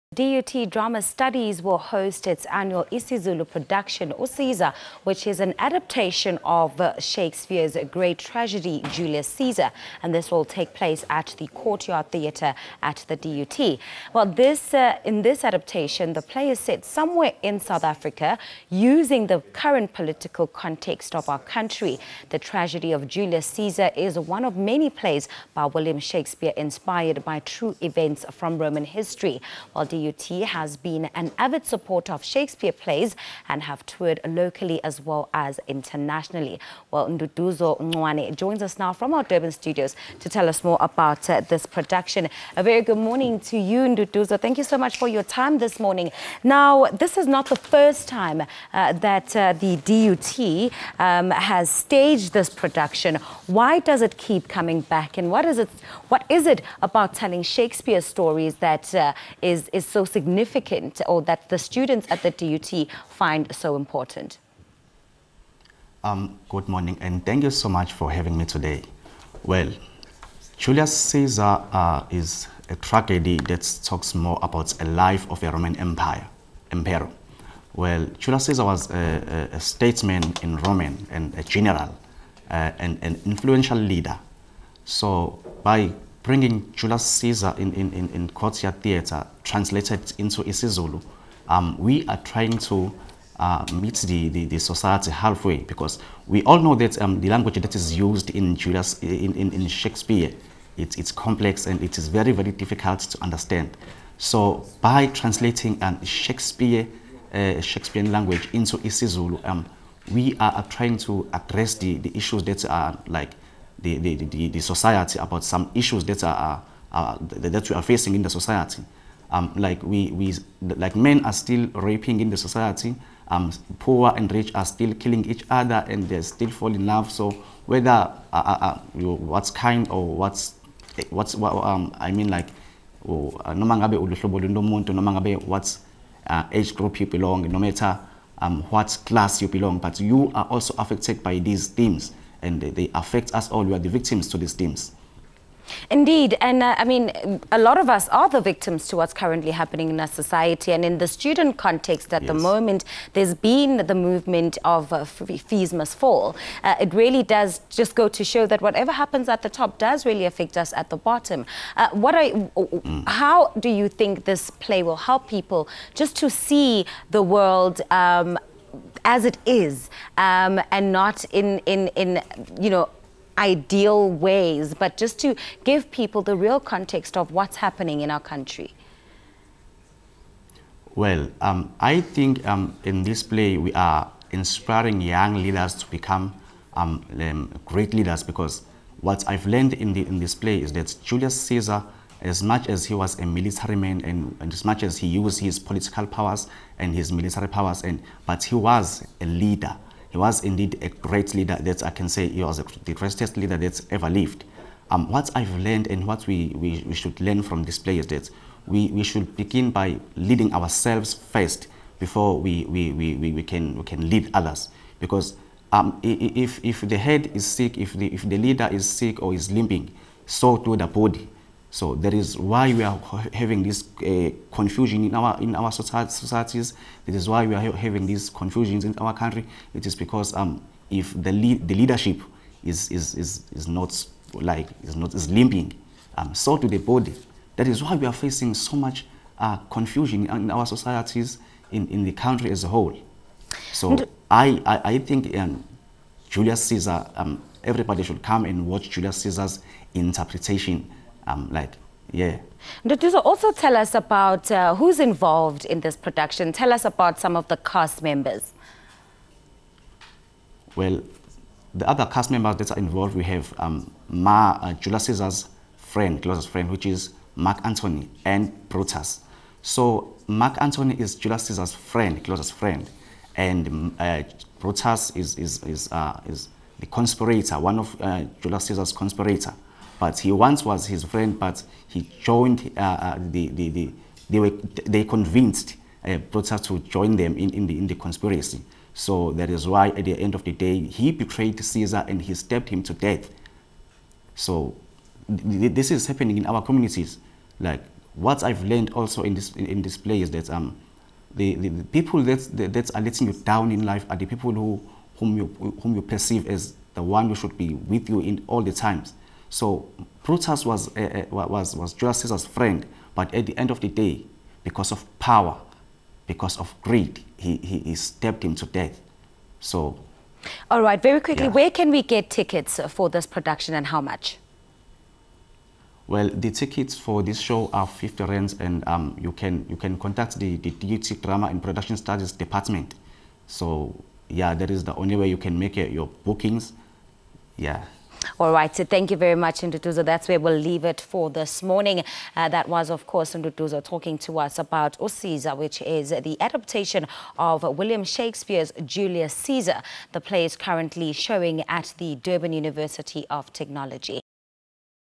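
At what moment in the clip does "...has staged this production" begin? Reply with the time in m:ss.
0:51.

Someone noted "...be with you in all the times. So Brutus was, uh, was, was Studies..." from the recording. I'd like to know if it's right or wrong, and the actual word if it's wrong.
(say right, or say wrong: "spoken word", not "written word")
wrong: "Julius", not "Studies".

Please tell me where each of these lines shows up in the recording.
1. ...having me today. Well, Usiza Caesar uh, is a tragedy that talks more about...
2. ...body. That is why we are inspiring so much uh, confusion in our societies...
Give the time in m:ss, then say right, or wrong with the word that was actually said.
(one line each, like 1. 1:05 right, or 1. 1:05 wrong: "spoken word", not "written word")
1. 1:08 wrong: "Julius", not "Usiza"
2. 3:56 wrong: "facing", not "inspiring".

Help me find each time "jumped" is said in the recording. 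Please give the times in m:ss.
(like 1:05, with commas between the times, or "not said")
not said.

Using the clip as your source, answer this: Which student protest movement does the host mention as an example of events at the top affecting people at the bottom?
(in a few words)
Fees Must Fall.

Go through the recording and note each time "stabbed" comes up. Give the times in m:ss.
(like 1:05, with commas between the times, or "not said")
4:52, 5:17.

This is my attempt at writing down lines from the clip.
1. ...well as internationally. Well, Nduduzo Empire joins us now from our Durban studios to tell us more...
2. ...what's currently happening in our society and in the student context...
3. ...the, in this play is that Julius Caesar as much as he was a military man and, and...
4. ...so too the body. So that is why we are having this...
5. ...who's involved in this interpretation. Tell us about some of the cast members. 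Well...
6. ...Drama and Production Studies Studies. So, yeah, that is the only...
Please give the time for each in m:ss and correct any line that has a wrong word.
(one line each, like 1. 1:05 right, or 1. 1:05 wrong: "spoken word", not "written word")
1. 0:35 wrong: "Ncwane", not "Empire"
2. 2:28 right
3. 3:09 right
4. 3:40 right
5. 4:14 wrong: "production", not "interpretation"
6. 5:31 wrong: "Department", not "Studies".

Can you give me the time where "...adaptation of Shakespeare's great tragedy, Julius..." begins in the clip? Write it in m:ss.
0:05.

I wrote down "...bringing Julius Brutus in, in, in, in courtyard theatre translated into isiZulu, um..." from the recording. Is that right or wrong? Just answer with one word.
wrong.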